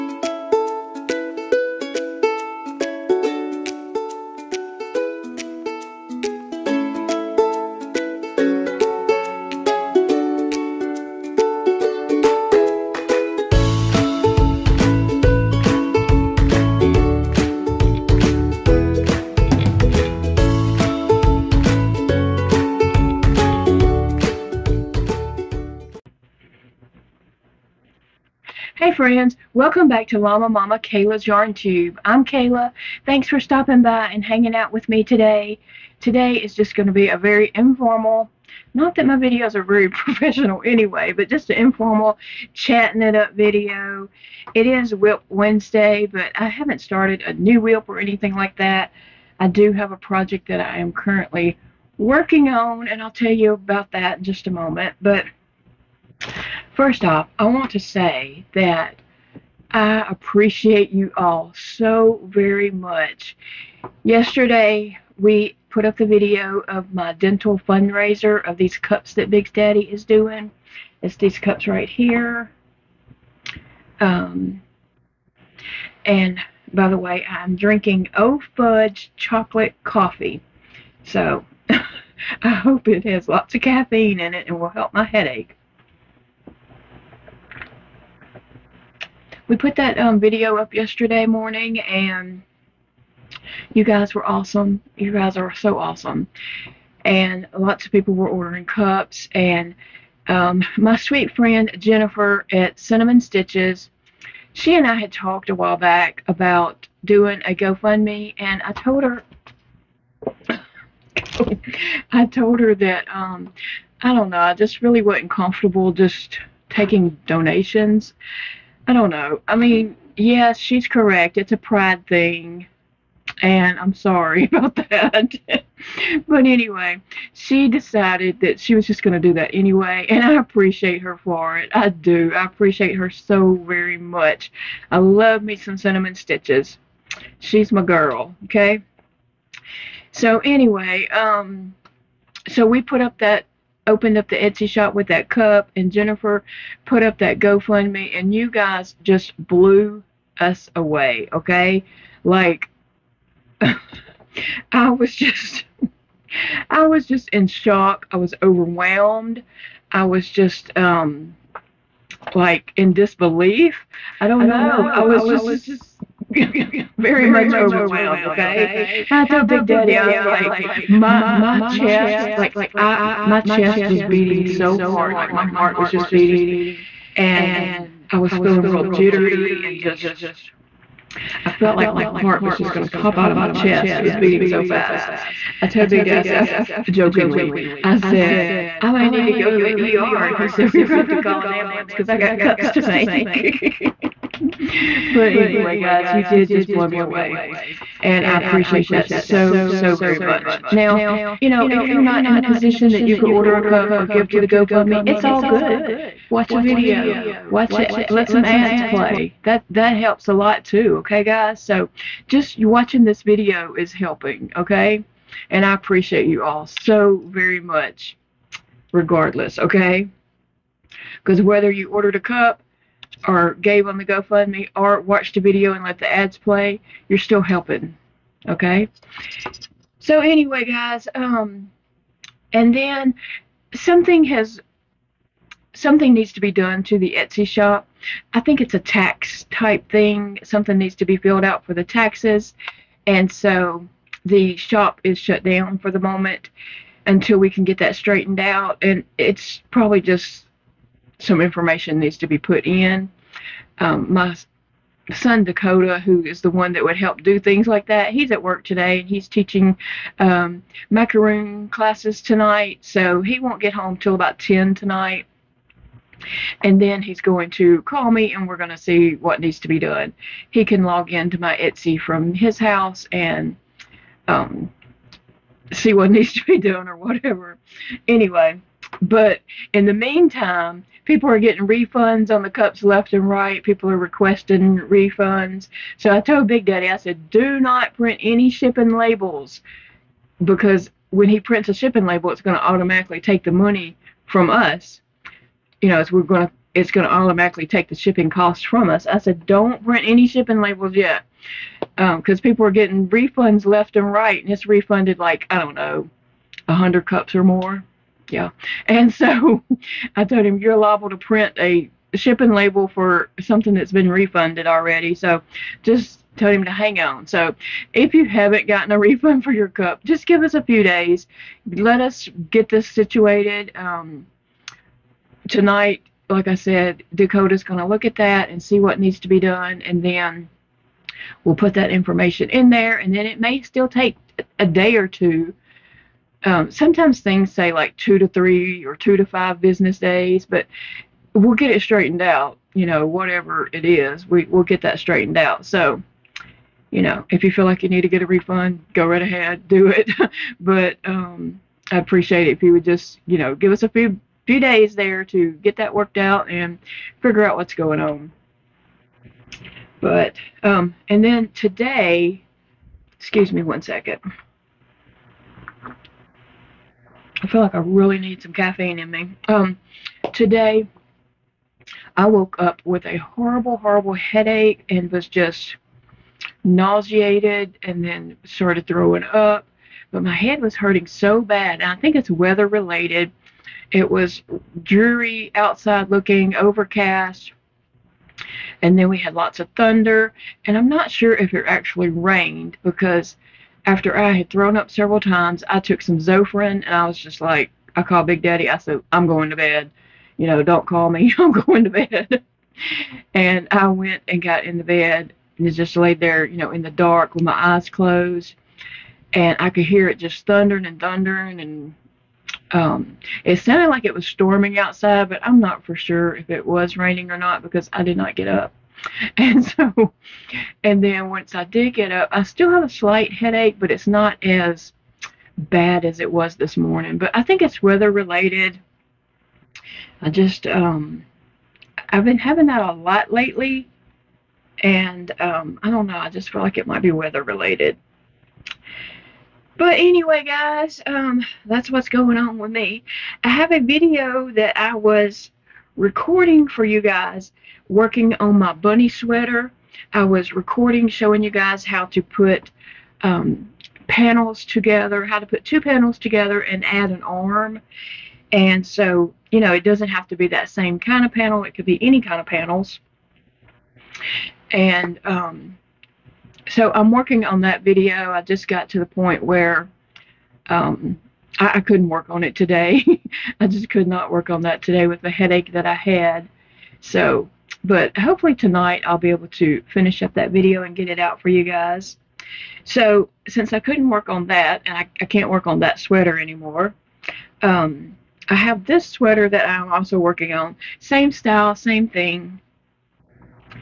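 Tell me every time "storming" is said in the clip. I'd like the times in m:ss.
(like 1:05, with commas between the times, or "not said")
6:54.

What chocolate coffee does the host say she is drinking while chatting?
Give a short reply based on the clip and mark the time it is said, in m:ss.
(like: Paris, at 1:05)
O Fudge, at 1:18.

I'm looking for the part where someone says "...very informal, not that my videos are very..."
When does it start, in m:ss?
0:37.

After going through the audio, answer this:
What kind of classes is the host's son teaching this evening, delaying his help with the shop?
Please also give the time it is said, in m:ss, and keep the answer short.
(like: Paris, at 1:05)
macaroon classes, at 4:20.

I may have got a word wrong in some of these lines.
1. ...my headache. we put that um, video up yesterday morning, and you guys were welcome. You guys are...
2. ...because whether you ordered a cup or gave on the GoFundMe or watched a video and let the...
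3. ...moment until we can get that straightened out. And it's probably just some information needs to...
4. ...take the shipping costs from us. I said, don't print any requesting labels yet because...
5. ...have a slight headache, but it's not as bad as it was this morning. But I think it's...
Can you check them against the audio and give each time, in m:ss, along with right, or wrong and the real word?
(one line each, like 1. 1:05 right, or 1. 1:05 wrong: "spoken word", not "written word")
1. 1:24 wrong: "awesome", not "welcome"
2. 3:41 right
3. 4:05 right
4. 4:57 wrong: "shipping", not "requesting"
5. 7:02 right.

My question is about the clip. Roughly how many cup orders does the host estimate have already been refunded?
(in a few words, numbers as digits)
100 or more.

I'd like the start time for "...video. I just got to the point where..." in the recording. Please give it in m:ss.
7:47.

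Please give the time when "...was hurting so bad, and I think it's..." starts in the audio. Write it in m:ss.
6:20.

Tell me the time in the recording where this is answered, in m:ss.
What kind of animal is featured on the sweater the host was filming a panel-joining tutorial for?
7:28.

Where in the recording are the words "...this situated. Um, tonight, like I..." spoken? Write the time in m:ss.
5:22.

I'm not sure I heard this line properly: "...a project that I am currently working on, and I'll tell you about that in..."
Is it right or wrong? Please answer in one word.
right.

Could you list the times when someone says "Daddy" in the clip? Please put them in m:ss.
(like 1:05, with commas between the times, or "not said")
1:09, 2:49, 4:46, 6:38.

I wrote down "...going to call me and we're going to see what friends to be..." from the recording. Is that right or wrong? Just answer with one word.
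wrong.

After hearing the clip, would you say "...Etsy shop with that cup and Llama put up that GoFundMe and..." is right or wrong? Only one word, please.
wrong.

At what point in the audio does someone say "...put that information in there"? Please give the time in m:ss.
5:31.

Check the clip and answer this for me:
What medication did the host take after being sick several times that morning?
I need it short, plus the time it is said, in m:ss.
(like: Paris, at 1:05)
Zofran, at 6:36.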